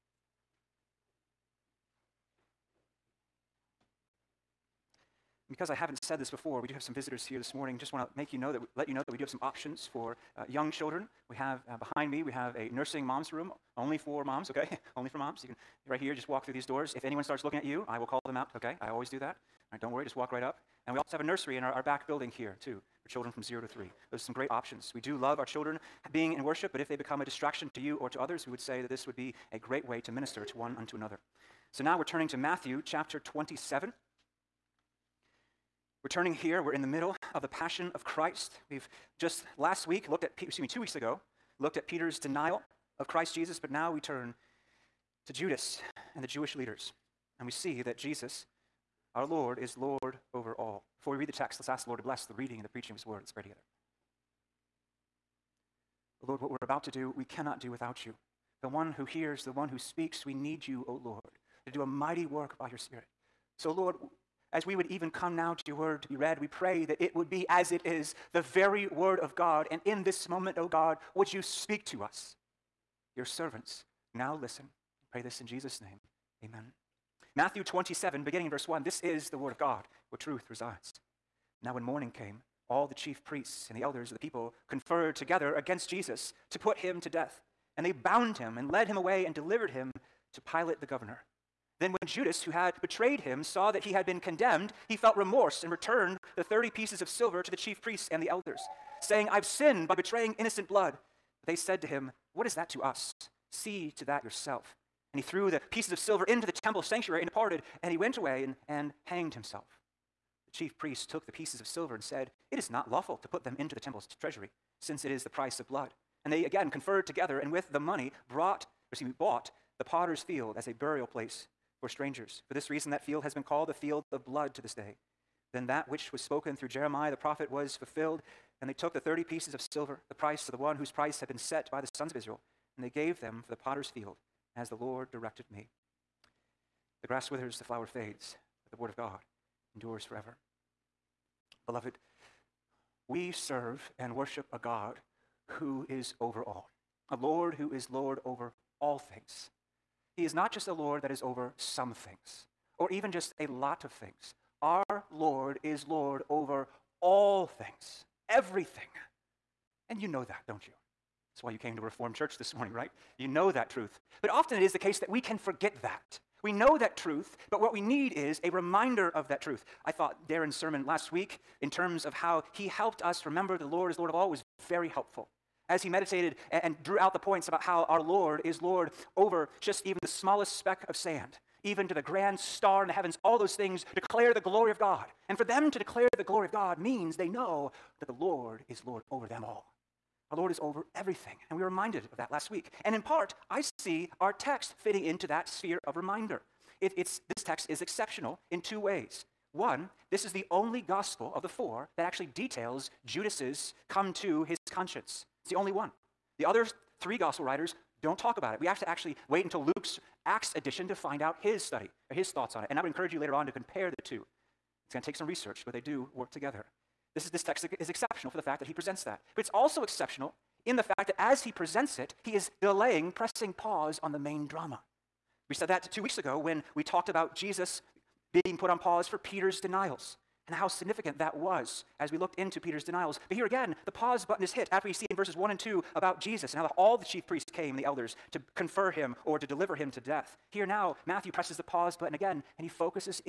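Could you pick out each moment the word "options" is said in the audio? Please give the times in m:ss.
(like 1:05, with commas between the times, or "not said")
0:09, 0:24.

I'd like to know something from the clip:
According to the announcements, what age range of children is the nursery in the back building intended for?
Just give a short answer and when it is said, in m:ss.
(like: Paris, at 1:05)
0 to 3, at 0:23.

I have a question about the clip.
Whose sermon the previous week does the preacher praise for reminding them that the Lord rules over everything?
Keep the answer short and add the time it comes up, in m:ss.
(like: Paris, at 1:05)
Darren, at 2:50.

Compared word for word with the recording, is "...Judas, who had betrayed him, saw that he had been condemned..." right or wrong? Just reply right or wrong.
right.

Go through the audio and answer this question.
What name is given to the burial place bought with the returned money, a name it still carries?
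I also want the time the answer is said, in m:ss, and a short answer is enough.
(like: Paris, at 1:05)
The field of blood, at 2:03.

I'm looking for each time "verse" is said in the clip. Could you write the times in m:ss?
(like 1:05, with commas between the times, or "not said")
1:18, 3:55.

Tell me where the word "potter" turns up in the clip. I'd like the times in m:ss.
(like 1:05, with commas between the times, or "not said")
1:59, 2:13.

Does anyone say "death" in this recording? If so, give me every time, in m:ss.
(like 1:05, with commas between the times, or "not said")
1:27, 3:59.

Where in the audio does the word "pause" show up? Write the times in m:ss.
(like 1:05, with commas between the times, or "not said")
3:43, 3:48, 3:53, 4:01.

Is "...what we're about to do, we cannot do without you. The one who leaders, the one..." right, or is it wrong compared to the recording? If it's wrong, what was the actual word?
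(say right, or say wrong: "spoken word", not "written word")
wrong: "hears", not "leaders".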